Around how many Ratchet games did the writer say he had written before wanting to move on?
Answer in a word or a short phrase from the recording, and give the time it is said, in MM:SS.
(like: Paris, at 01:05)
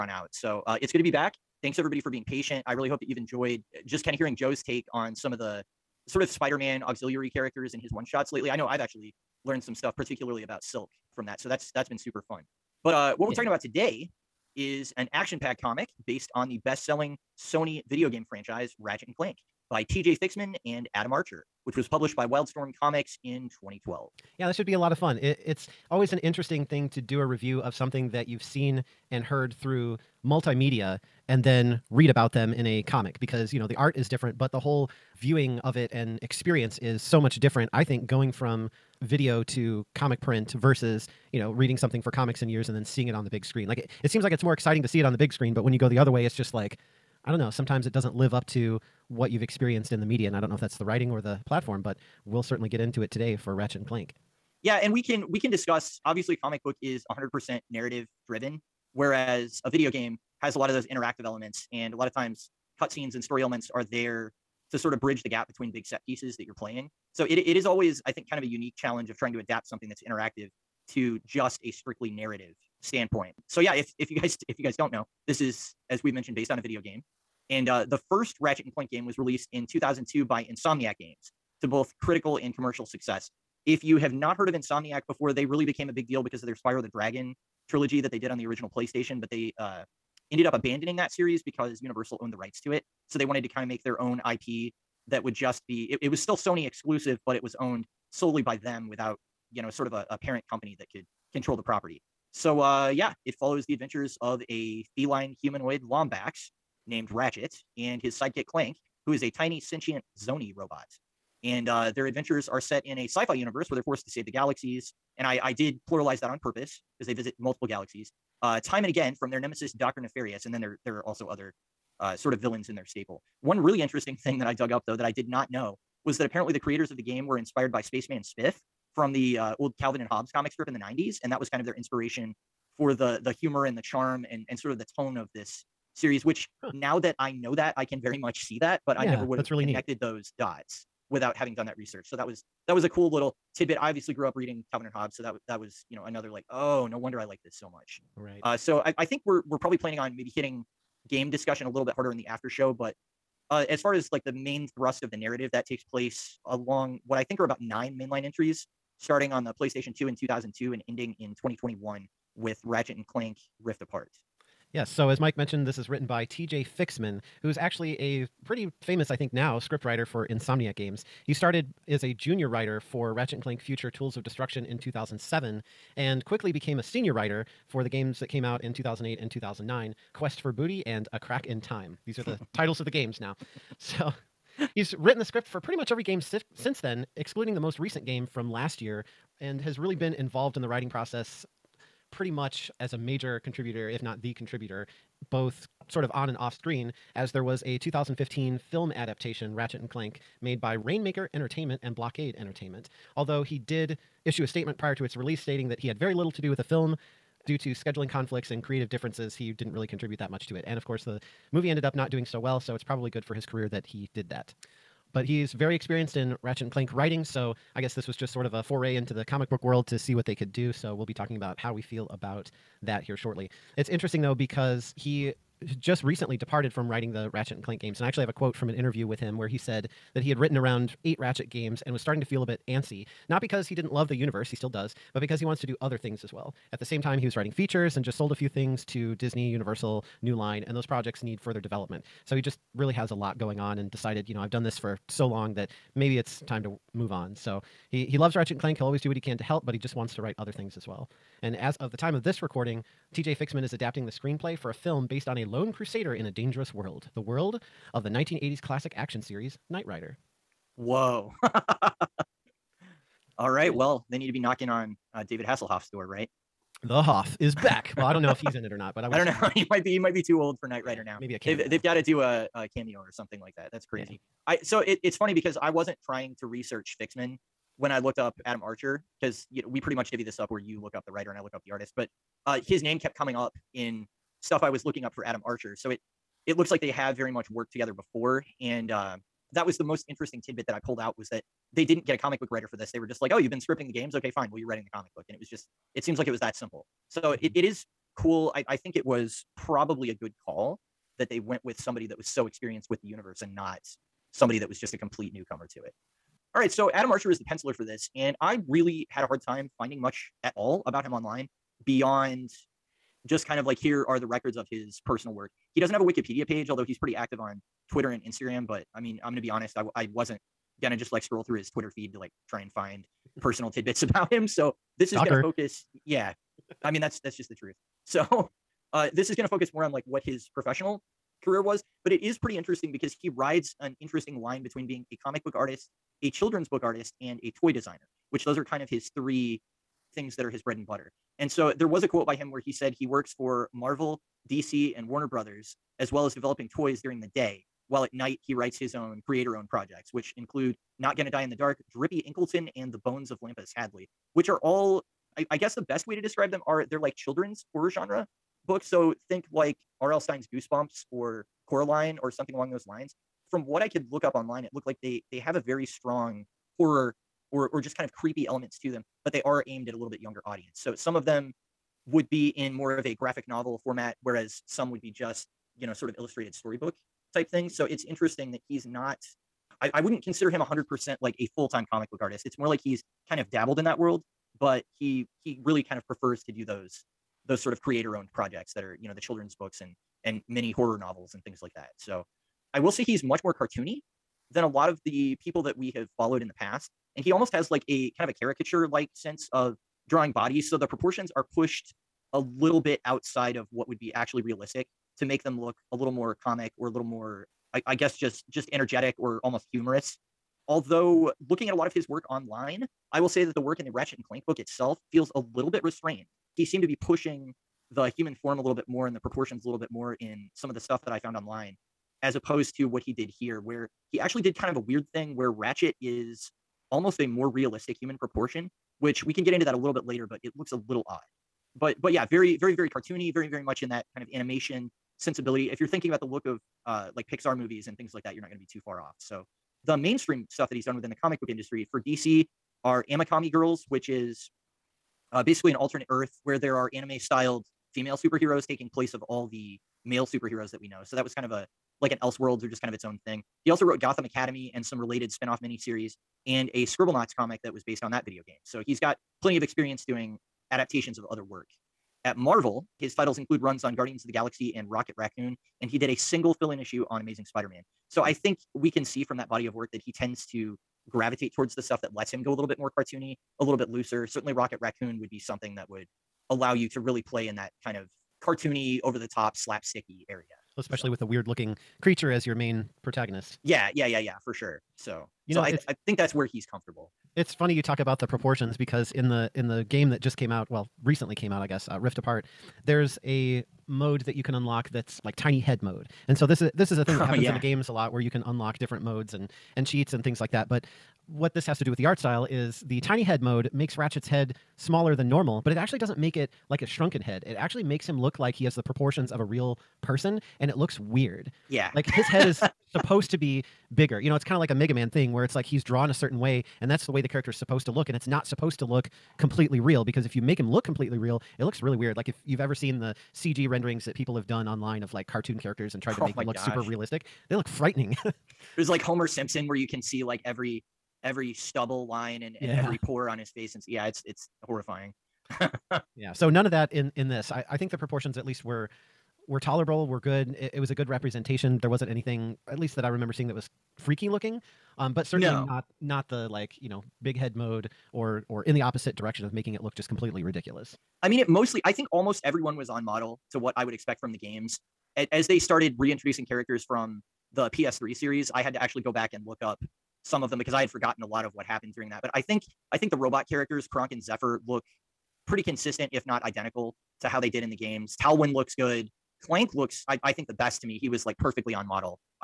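8, at 03:51.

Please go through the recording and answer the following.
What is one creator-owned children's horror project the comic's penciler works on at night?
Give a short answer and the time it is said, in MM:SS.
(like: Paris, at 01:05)
Drippy Inkleton, at 05:51.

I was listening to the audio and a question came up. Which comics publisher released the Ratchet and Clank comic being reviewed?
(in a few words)
Wildstorm Comics.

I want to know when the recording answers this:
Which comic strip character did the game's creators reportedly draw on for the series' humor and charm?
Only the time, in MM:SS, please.
02:07.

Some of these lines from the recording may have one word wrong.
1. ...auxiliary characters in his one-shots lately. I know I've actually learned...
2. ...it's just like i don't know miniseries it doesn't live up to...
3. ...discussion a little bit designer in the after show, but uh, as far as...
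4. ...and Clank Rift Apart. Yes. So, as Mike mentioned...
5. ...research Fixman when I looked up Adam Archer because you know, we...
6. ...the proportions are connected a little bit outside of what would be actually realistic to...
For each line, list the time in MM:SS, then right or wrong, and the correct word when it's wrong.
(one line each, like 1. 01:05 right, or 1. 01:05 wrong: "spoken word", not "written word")
1. 00:06 right
2. 00:46 wrong: "sometimes", not "miniseries"
3. 02:31 wrong: "harder", not "designer"
4. 02:42 right
5. 04:36 right
6. 06:40 wrong: "pushed", not "connected".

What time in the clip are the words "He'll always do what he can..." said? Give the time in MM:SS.
04:08.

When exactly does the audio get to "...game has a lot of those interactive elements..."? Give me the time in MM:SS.
00:59.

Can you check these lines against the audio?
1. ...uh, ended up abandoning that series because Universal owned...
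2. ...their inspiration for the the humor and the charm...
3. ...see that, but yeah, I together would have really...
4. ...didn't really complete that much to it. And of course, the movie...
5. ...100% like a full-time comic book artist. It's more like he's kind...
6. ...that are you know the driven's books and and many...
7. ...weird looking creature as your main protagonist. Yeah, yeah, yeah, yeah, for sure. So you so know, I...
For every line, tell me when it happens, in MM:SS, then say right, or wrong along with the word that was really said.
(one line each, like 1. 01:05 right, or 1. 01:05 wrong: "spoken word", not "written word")
1. 01:29 right
2. 02:11 right
3. 02:18 wrong: "never", not "together"
4. 03:29 wrong: "contribute", not "complete"
5. 06:20 right
6. 06:28 wrong: "children", not "driven"
7. 08:01 right.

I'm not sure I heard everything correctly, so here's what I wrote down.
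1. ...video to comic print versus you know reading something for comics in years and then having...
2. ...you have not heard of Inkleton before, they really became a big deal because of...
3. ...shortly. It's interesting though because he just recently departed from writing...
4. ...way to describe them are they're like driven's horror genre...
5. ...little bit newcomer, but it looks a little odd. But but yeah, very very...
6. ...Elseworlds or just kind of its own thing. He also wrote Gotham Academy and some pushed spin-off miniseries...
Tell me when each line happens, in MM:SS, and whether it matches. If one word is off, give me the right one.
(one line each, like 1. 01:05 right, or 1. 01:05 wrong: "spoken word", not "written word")
1. 00:39 wrong: "seeing", not "having"
2. 01:23 wrong: "Insomniac", not "Inkleton"
3. 03:43 right
4. 05:56 wrong: "children", not "driven"
5. 07:09 wrong: "later", not "newcomer"
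6. 07:32 wrong: "related", not "pushed".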